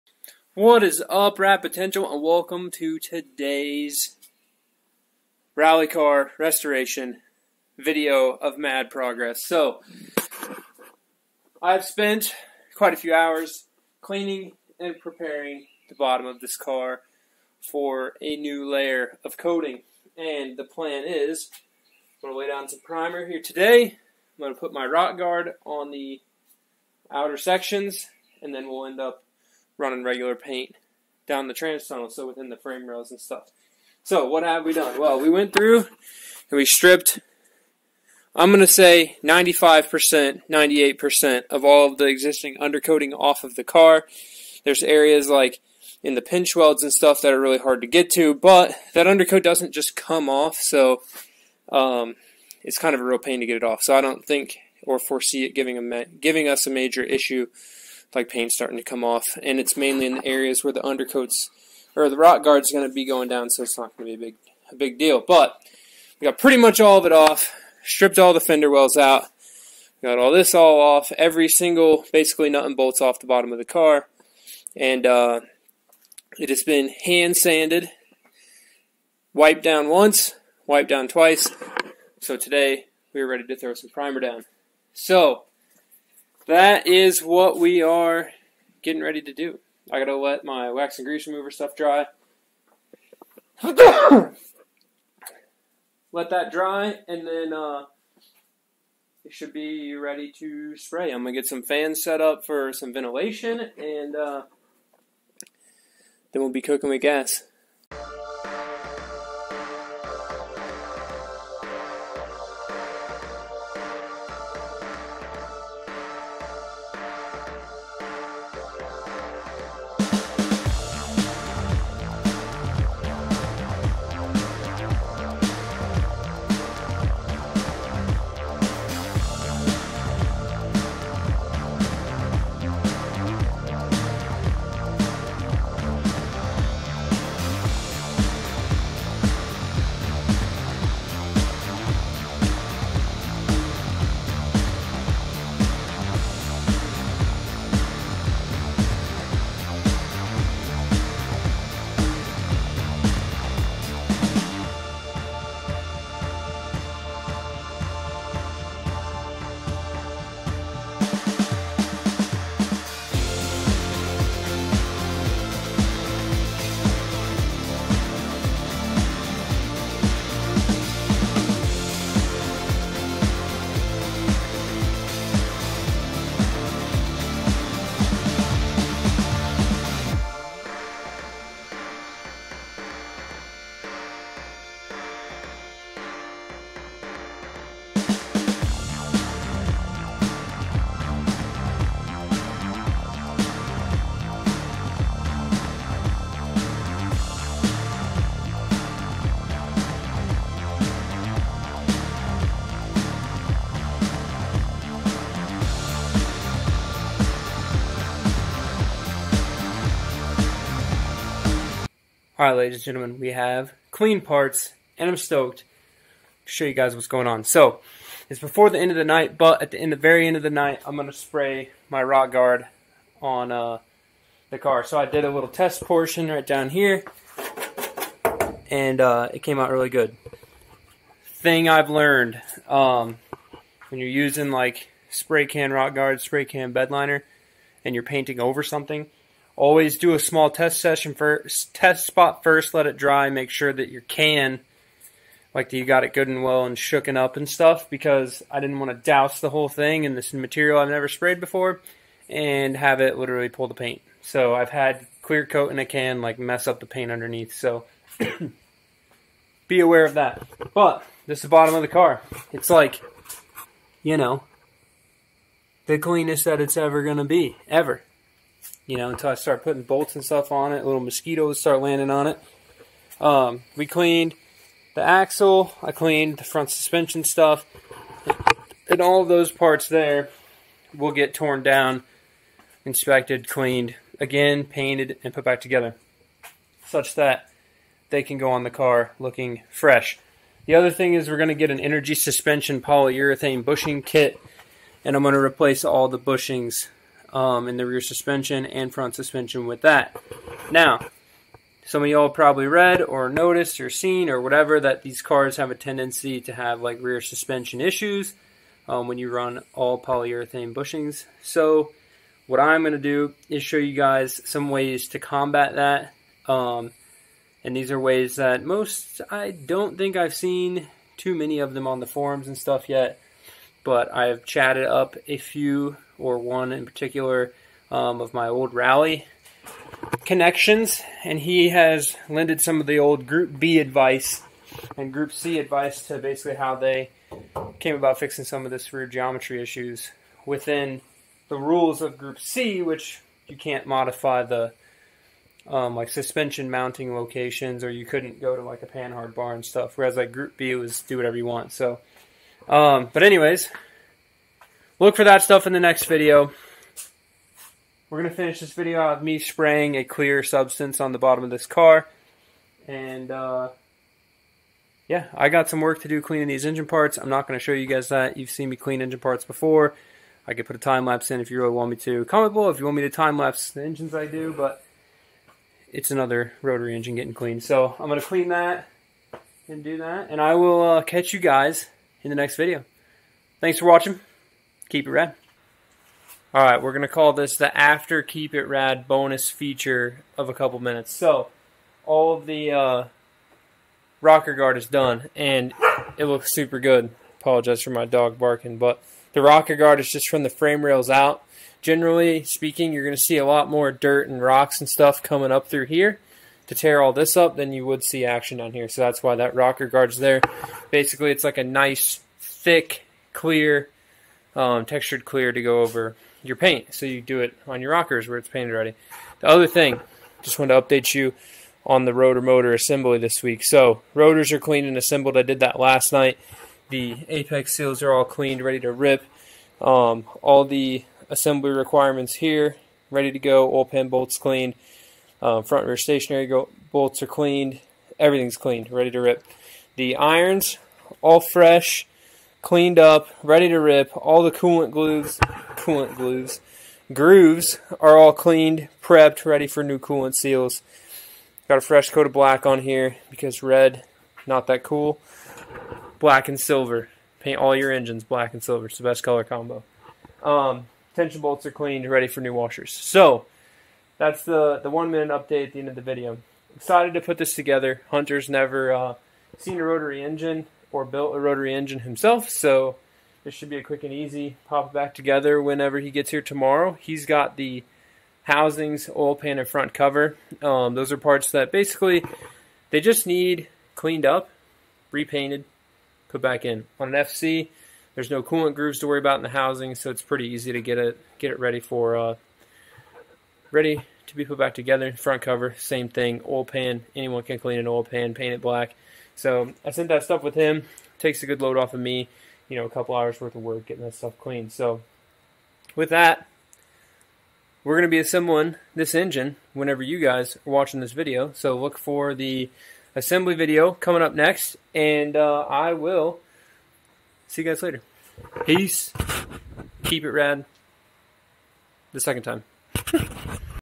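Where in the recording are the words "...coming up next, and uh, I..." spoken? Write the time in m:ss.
8:33.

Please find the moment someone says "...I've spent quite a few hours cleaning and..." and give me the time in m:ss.
0:11.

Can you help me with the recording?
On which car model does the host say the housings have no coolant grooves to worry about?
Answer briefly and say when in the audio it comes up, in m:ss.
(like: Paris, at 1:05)
FC, at 8:07.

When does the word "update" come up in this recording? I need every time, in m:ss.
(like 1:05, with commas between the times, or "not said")
7:00, 7:45.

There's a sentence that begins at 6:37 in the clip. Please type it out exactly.
Apologize for my dog barking, but the rocker guard is just from the frame rails out.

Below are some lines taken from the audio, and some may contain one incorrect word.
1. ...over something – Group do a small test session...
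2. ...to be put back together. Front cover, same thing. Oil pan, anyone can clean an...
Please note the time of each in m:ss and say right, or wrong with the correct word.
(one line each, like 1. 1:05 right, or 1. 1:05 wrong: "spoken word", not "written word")
1. 3:58 wrong: "Always", not "Group"
2. 8:14 right.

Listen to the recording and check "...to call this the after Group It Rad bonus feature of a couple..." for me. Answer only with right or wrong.
wrong.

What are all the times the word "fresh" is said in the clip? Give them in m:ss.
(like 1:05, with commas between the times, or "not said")
4:49, 7:21, 7:31.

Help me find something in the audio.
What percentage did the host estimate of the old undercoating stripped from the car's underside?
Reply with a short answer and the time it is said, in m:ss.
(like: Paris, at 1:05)
95%, 98%, at 0:39.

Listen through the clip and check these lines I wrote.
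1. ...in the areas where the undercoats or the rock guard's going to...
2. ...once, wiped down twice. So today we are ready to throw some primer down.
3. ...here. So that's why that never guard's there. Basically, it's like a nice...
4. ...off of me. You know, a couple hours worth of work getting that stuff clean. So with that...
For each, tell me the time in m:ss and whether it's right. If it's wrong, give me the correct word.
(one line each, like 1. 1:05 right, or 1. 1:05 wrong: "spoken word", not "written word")
1. 1:00 right
2. 1:19 right
3. 6:48 wrong: "rocker", not "never"
4. 8:21 right.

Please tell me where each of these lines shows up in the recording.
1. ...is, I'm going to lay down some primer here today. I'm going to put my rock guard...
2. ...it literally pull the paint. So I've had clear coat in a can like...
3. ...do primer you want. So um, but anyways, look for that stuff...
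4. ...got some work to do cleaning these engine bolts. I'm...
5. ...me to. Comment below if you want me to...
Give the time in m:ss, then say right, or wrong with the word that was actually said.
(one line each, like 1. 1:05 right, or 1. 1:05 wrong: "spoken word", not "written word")
1. 0:21 right
2. 4:13 right
3. 5:51 wrong: "whatever", not "primer"
4. 6:05 wrong: "parts", not "bolts"
5. 6:11 right.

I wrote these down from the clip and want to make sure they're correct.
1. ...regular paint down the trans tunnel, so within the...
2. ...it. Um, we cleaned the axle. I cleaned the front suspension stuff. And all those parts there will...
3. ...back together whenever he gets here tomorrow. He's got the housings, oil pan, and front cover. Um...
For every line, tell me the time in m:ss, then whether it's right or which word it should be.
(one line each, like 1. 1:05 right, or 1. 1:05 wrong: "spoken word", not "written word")
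1. 0:30 right
2. 4:32 right
3. 7:54 right.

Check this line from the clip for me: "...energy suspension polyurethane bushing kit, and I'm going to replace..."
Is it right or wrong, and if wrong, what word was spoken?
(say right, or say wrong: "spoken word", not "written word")
right.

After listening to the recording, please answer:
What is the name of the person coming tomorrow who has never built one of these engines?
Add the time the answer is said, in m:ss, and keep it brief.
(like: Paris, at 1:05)
Hunter, at 7:48.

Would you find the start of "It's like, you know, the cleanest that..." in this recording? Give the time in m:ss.
4:22.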